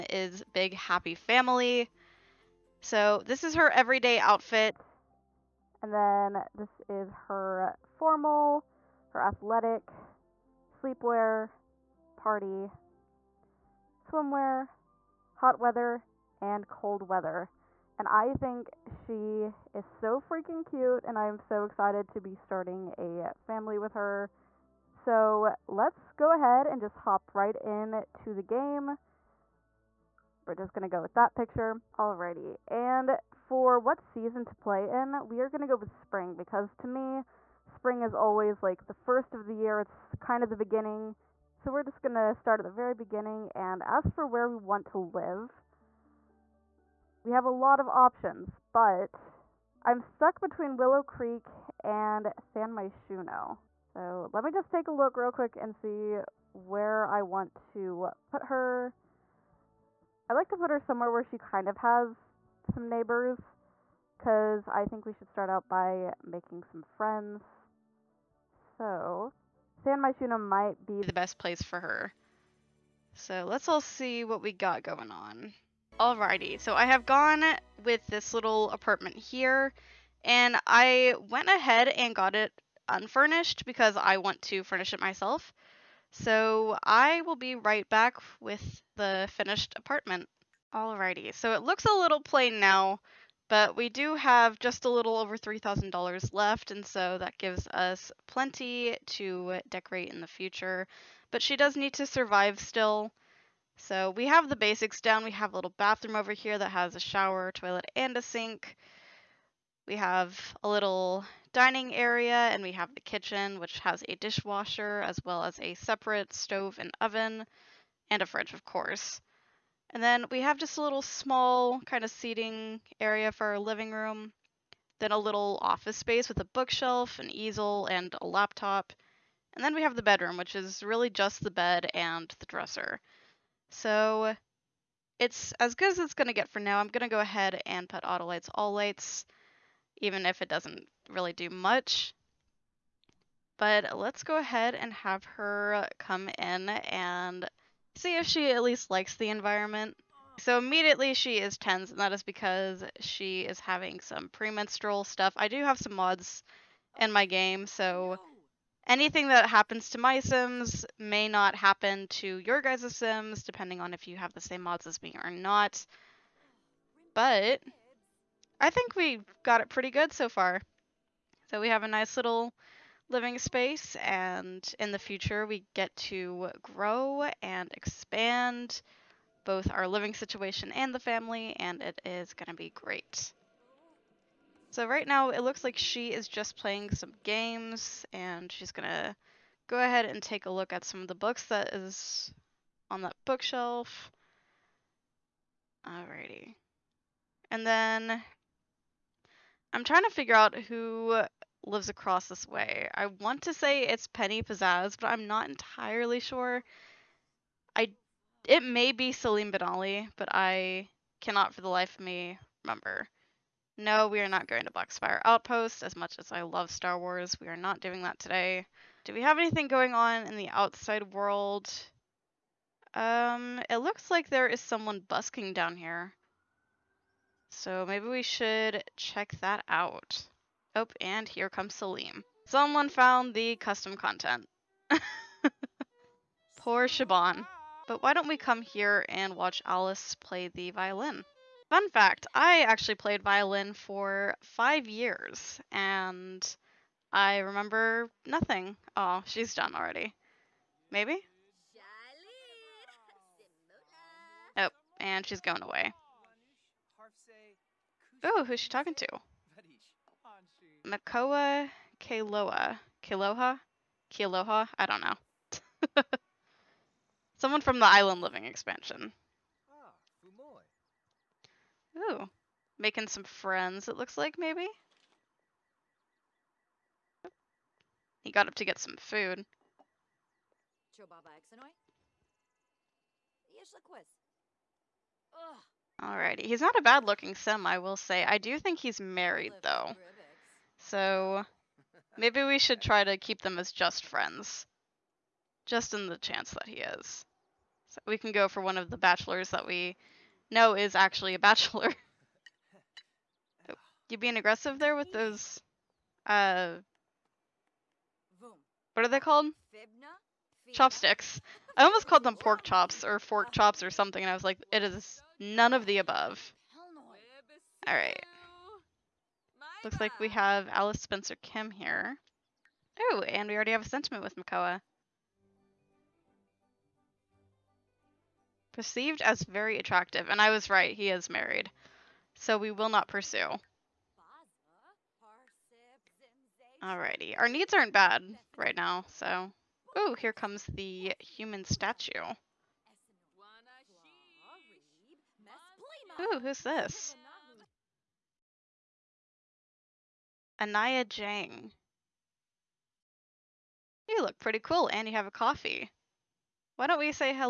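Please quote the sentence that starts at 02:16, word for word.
I'm going to go ahead and put auto lights, all lights, even if it doesn't really do much.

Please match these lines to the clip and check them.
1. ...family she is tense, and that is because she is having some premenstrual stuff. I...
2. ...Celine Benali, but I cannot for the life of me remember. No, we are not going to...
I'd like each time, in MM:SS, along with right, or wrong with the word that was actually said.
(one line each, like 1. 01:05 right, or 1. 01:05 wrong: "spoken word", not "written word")
1. 02:30 wrong: "immediately", not "family"
2. 03:29 right.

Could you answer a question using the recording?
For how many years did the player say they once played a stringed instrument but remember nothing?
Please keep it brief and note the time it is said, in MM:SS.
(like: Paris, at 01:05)
5, at 04:04.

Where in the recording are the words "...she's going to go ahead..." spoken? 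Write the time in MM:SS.
03:08.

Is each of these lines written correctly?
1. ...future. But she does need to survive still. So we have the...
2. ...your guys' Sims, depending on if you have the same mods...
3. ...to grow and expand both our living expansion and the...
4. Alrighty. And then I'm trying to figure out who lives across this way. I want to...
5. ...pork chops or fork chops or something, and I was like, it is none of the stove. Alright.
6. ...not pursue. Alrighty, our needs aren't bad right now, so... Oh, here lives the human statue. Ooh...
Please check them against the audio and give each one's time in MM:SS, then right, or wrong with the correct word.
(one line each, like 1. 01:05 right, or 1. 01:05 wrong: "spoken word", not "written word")
1. 01:40 right
2. 02:42 right
3. 02:55 wrong: "situation", not "expansion"
4. 03:15 right
5. 05:12 wrong: "above", not "stove"
6. 05:32 wrong: "comes", not "lives".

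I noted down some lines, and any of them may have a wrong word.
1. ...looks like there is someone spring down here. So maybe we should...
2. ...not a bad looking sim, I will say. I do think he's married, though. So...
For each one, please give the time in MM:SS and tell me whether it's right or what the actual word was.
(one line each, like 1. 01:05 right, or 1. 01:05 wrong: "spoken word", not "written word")
1. 03:43 wrong: "busking", not "spring"
2. 04:46 right.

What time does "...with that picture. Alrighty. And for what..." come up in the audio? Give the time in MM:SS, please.
00:31.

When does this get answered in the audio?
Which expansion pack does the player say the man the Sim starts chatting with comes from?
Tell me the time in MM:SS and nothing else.
04:27.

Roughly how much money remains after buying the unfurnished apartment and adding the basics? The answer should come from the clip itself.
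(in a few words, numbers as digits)
$3,000.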